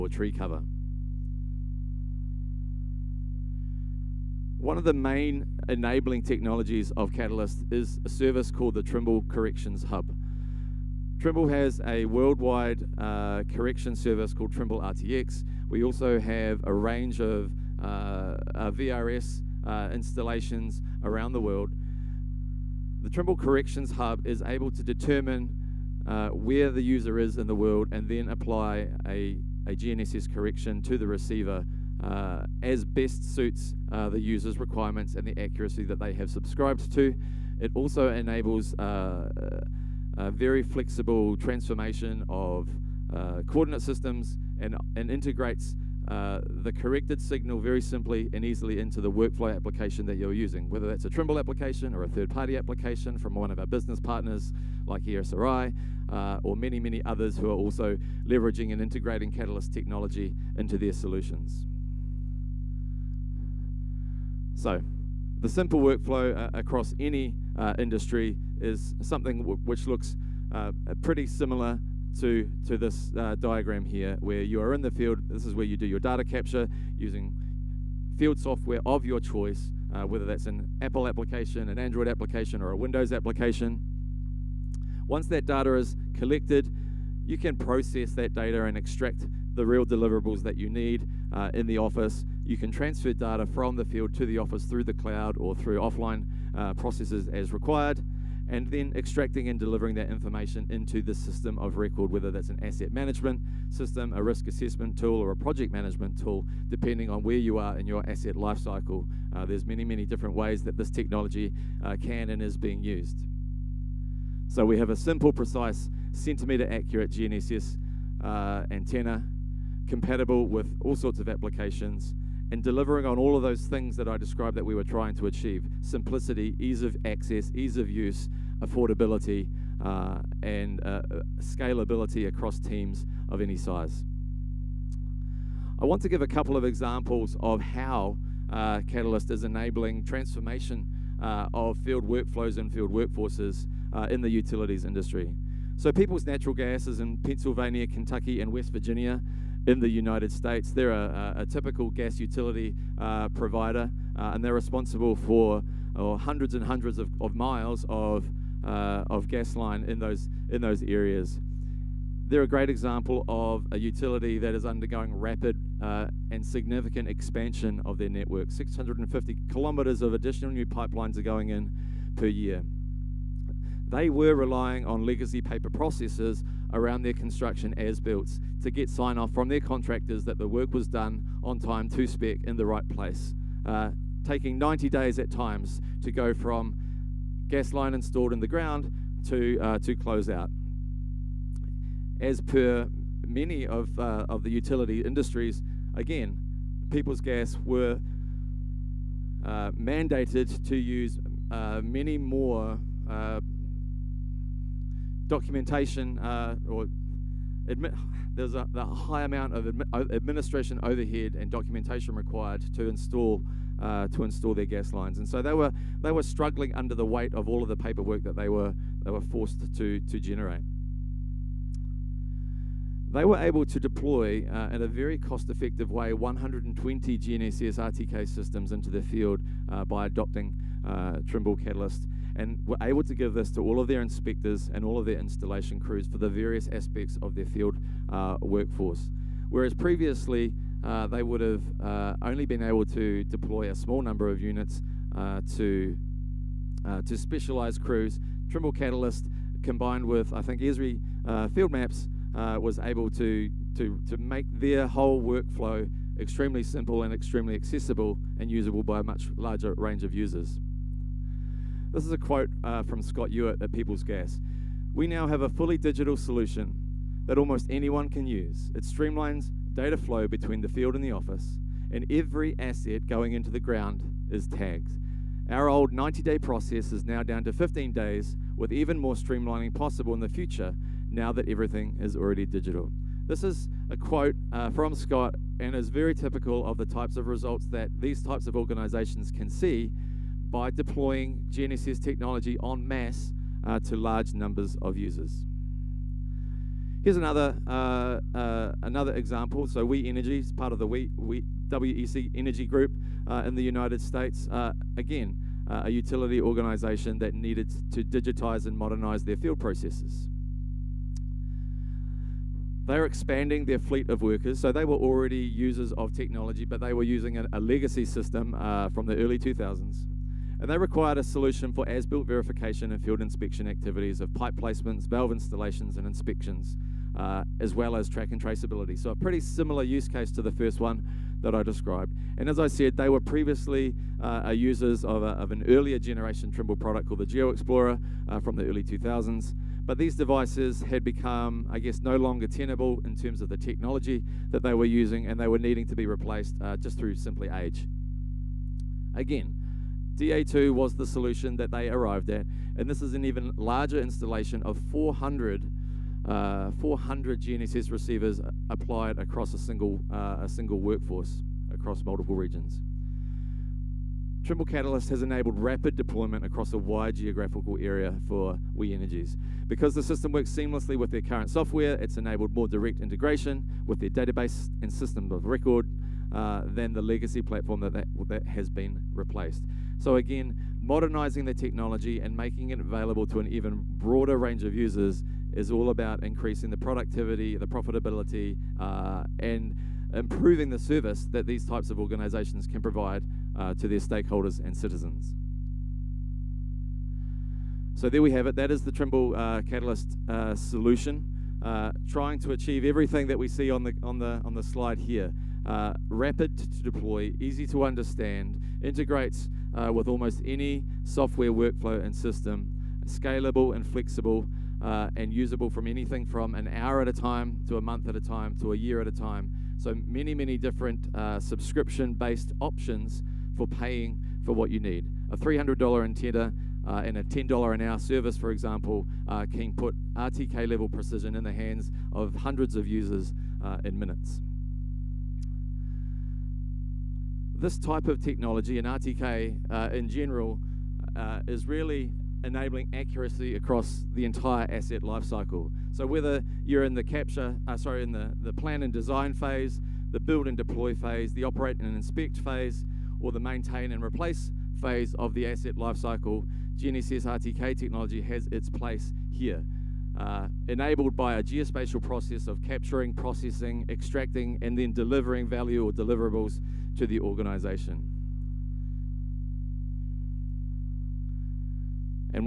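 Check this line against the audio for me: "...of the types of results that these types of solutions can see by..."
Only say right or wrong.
wrong.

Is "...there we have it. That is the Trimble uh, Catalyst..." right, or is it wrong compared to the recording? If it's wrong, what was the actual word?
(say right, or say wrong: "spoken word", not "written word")
right.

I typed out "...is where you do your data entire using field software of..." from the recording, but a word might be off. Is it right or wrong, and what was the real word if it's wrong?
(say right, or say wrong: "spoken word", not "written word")
wrong: "capture", not "entire".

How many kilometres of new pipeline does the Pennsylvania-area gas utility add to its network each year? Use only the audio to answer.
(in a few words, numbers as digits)
650 kilometres.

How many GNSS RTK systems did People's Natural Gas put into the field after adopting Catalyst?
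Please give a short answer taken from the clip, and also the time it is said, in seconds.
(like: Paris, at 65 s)
120, at 226 s.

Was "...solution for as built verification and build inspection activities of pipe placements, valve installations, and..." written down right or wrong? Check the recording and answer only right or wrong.
wrong.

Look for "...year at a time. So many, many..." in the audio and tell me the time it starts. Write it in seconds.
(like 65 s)
418 s.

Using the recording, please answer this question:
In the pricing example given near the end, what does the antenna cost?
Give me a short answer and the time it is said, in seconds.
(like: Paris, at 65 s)
$300, at 425 s.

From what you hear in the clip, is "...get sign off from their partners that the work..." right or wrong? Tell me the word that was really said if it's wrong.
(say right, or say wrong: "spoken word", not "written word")
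wrong: "contractors", not "partners".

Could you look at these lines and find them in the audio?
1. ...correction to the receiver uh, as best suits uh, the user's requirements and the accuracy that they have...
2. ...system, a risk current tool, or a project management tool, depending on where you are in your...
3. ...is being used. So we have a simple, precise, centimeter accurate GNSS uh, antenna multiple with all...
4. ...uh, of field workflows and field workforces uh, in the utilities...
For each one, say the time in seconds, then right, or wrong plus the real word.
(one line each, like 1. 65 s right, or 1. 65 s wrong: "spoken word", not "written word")
1. 30 s right
2. 103 s wrong: "assessment", not "current"
3. 112 s wrong: "compatible", not "multiple"
4. 141 s right.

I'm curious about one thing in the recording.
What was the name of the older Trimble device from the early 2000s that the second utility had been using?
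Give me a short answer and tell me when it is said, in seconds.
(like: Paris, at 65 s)
GeoExplorer, at 337 s.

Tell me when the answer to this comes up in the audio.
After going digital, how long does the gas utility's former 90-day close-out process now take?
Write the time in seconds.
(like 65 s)
277 s.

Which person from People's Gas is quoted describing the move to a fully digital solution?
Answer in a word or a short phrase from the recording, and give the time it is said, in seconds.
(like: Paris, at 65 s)
Scott Ewart, at 263 s.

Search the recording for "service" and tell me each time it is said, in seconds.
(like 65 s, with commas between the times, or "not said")
8 s, 13 s, 390 s, 427 s.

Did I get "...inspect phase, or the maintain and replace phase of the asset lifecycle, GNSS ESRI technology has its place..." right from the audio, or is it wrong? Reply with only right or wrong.
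wrong.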